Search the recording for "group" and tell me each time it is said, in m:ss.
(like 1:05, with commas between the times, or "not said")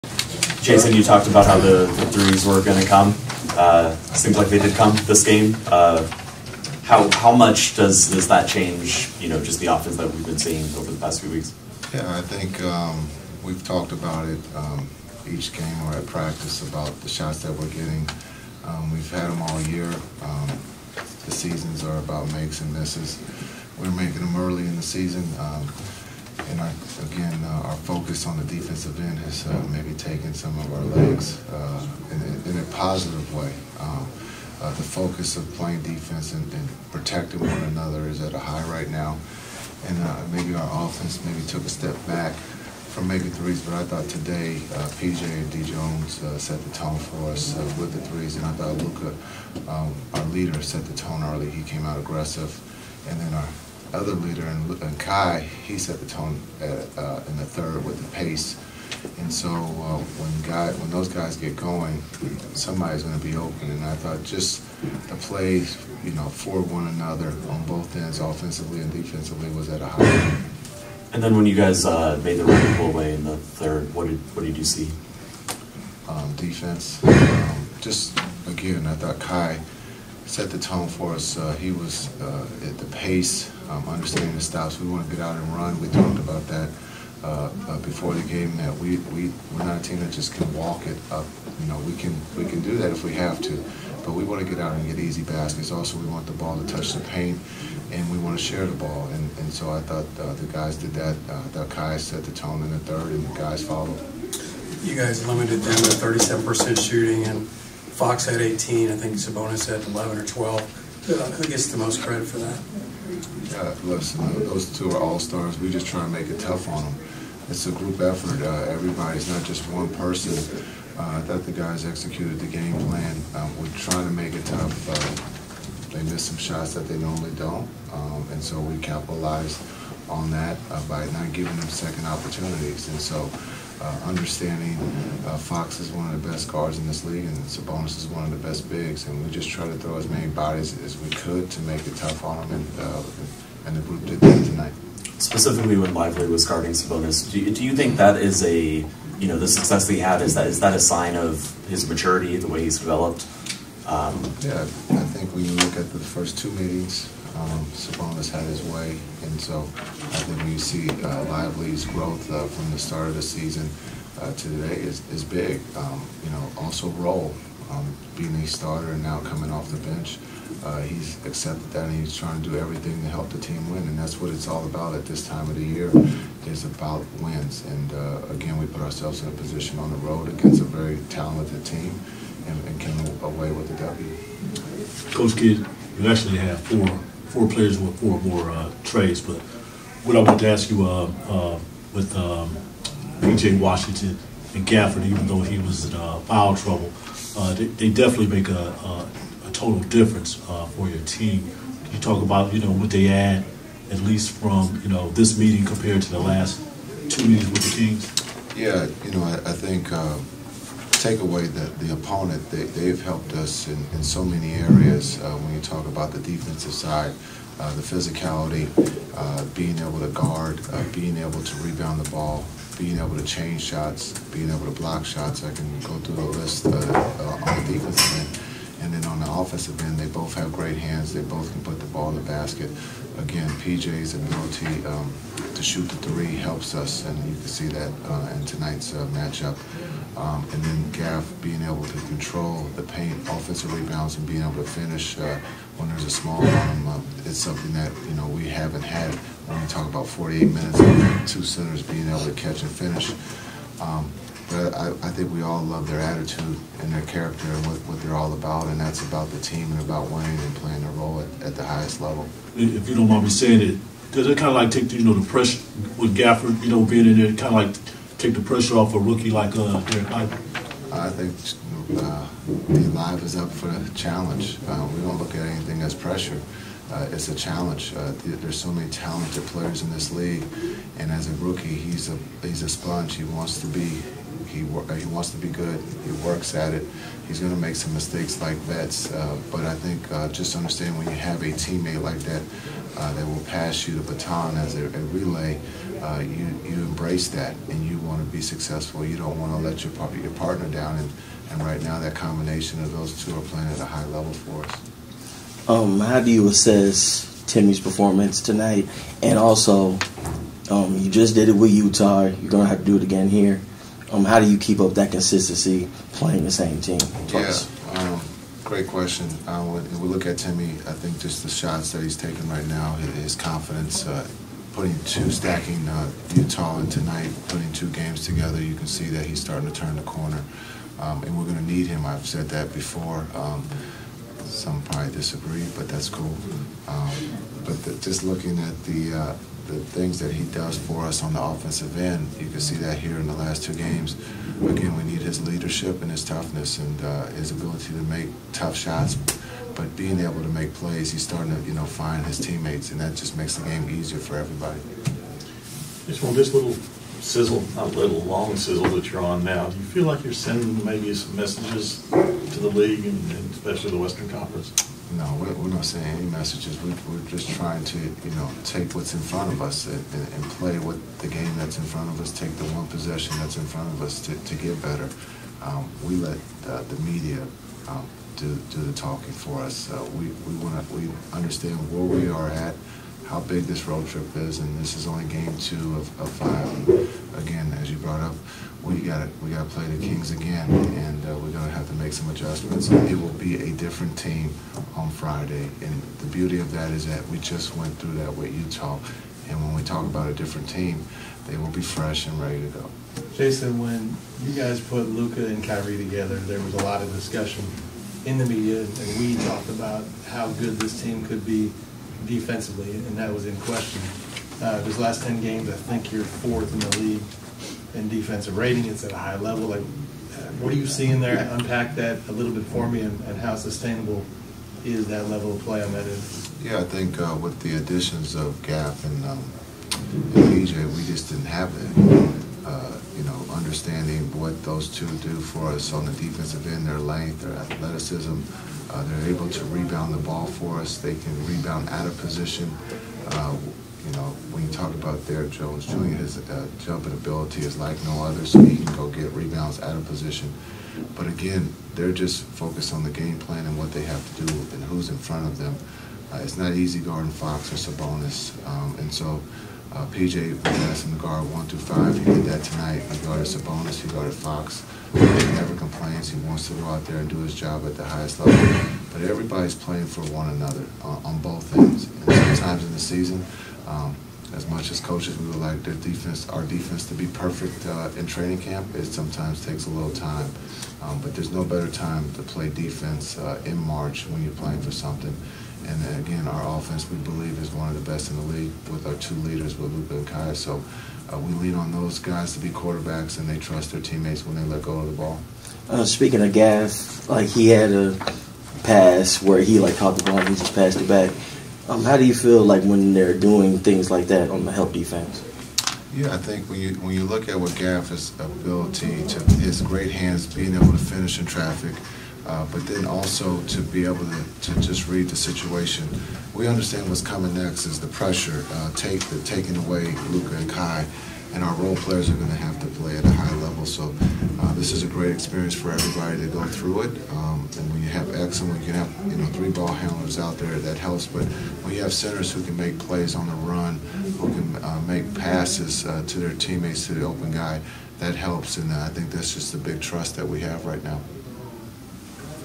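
1:57, 2:23.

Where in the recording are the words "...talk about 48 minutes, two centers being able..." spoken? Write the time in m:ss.
4:09.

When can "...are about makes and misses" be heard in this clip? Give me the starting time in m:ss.
0:21.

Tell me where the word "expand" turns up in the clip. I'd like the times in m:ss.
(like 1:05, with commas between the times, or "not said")
not said.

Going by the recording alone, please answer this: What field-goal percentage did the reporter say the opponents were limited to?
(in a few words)
37%.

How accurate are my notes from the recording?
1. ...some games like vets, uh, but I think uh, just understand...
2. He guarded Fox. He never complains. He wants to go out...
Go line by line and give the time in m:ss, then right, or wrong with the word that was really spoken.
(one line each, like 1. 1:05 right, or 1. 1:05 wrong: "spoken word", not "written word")
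1. 4:47 wrong: "mistakes", not "games"
2. 7:44 right.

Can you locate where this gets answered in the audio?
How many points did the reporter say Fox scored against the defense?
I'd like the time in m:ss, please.
1:48.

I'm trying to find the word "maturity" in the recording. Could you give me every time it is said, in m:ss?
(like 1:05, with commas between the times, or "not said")
2:31.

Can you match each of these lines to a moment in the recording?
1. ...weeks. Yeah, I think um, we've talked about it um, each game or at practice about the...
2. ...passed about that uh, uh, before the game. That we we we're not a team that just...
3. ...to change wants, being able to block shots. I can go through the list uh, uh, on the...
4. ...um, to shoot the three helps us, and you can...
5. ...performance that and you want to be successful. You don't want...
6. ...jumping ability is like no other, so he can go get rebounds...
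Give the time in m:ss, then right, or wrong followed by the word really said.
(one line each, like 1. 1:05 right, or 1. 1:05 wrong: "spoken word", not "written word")
1. 0:11 right
2. 1:25 wrong: "talked", not "passed"
3. 3:43 wrong: "shots", not "wants"
4. 3:54 right
5. 4:56 wrong: "embrace", not "performance"
6. 7:26 right.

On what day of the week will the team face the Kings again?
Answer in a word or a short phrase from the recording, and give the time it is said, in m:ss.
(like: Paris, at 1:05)
Friday, at 6:35.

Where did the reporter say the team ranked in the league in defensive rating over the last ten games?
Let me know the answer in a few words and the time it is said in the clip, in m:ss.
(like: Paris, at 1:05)
fourth, at 6:56.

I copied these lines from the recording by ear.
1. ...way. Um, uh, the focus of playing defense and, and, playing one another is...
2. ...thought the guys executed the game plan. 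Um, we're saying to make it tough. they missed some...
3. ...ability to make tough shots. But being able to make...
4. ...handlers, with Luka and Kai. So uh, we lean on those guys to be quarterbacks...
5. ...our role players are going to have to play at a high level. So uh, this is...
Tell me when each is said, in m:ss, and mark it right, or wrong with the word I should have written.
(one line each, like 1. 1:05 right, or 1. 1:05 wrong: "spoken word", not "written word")
1. 0:33 wrong: "protecting", not "playing"
2. 2:01 wrong: "trying", not "saying"
3. 5:47 right
4. 8:09 wrong: "leaders", not "handlers"
5. 8:41 right.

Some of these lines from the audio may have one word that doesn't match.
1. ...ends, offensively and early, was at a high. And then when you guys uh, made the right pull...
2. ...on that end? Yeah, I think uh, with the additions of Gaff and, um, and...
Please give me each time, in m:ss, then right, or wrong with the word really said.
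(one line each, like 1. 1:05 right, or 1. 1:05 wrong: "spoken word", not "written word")
1. 1:07 wrong: "defensively", not "early"
2. 7:05 right.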